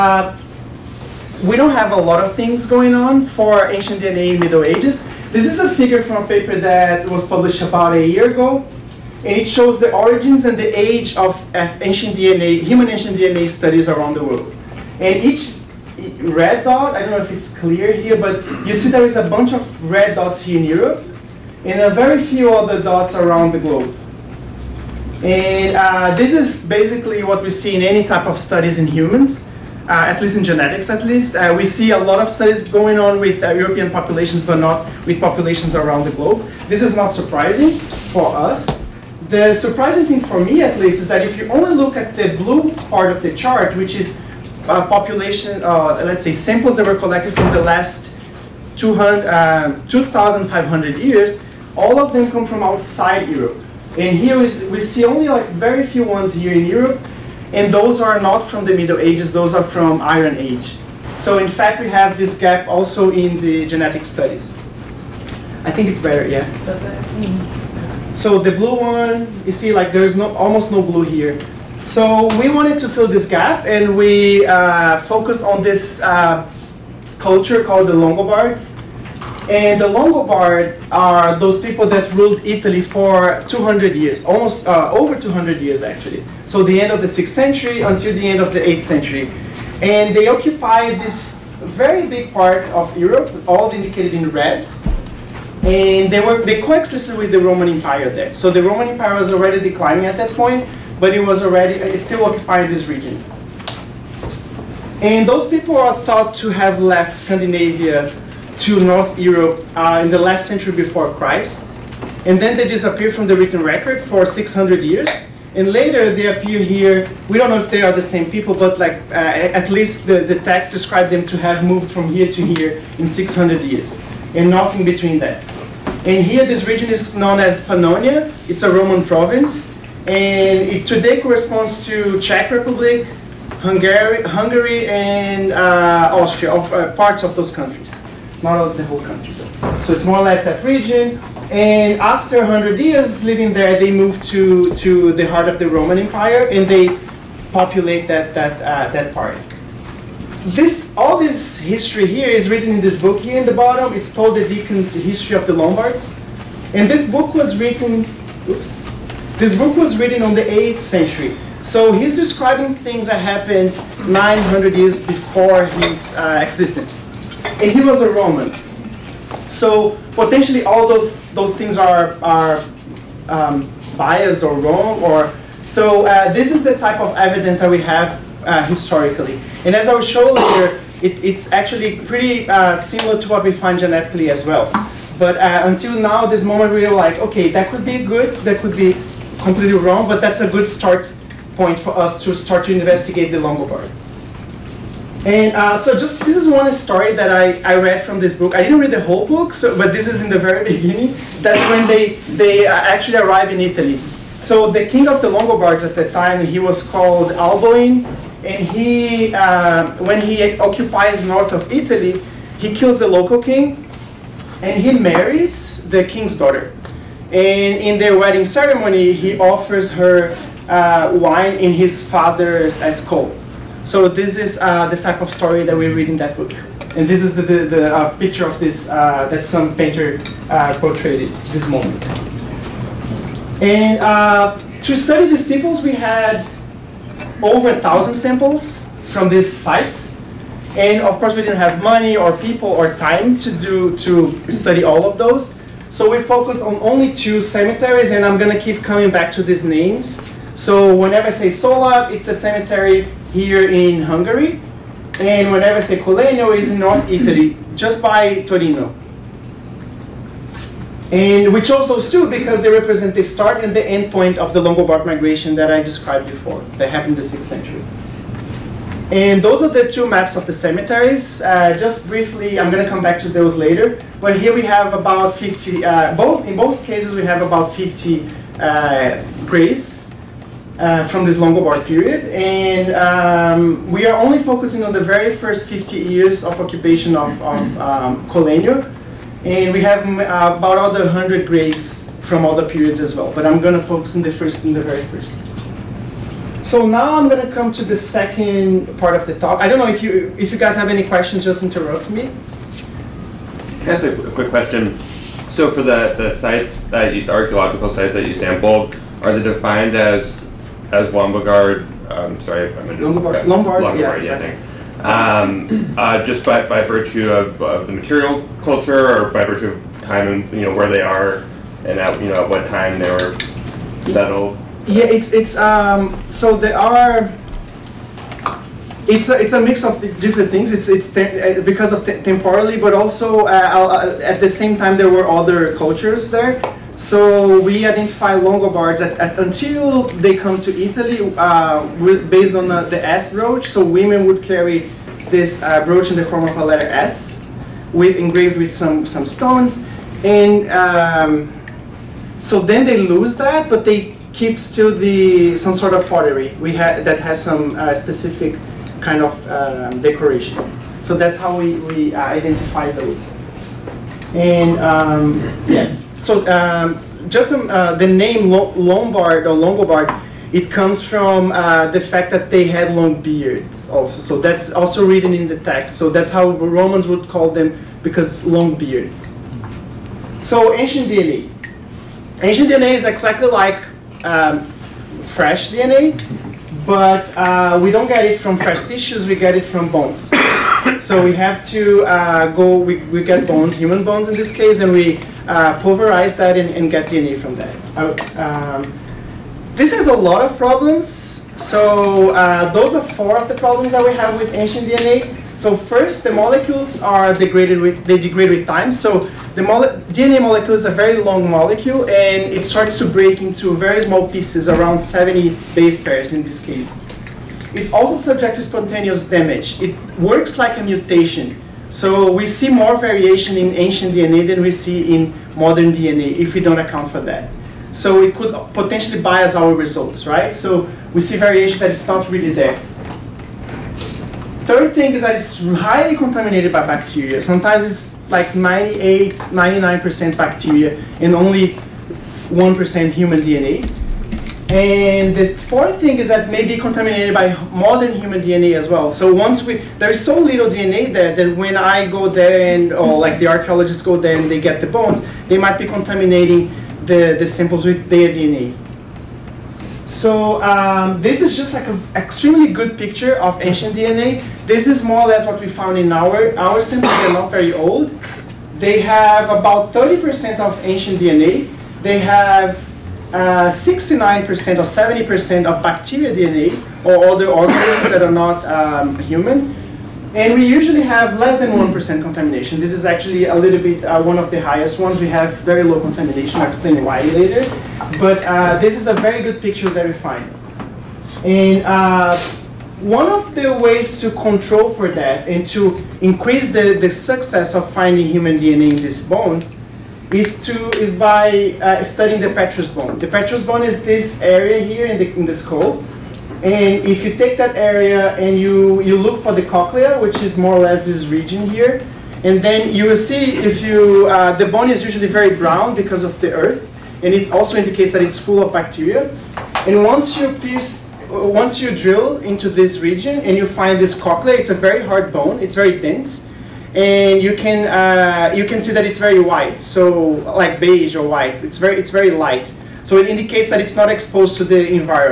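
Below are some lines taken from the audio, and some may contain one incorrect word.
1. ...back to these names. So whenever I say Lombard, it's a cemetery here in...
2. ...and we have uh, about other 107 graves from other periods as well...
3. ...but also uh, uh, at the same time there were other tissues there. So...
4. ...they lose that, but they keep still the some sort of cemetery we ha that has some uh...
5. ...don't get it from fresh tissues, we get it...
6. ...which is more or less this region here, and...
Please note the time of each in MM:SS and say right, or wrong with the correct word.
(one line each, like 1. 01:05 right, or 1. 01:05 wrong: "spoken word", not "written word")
1. 04:09 wrong: "Szólád", not "Lombard"
2. 04:49 wrong: "100", not "107"
3. 05:32 wrong: "cultures", not "tissues"
4. 05:52 wrong: "pottery", not "cemetery"
5. 06:27 right
6. 08:30 right.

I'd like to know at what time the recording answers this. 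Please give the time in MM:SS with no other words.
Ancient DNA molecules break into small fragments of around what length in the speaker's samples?
06:54.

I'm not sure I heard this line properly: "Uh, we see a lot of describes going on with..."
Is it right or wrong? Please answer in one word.
wrong.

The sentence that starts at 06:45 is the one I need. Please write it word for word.
So first, the molecules are degraded with, they degrade with time.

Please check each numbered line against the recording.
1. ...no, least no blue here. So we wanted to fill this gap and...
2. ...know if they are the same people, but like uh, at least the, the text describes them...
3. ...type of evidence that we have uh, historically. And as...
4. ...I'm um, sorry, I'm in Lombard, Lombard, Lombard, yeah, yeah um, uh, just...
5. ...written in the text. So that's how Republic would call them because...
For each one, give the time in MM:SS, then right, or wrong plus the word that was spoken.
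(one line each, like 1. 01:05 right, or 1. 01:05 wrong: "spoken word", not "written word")
1. 01:10 wrong: "almost", not "least"
2. 01:57 right
3. 02:56 right
4. 05:12 right
5. 06:15 wrong: "Romans", not "Republic".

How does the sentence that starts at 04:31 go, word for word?
Uh, just briefly, I'm going to come back to those later.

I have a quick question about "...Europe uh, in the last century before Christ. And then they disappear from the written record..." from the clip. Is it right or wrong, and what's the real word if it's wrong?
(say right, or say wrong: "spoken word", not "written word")
right.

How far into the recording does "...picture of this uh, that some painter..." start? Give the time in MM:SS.
03:48.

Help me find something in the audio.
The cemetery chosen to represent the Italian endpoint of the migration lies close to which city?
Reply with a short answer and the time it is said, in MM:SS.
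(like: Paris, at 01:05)
Torino, at 04:18.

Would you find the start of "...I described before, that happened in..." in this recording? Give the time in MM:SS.
04:25.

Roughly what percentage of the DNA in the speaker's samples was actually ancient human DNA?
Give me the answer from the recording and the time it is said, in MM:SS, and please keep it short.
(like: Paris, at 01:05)
30%, at 07:49.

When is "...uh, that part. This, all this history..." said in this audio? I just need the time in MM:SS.
02:28.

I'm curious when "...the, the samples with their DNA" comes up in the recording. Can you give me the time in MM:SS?
07:37.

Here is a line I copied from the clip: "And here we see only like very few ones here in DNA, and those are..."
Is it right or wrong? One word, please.
wrong.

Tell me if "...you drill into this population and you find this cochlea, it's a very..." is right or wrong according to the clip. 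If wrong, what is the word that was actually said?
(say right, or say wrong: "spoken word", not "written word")
wrong: "region", not "population".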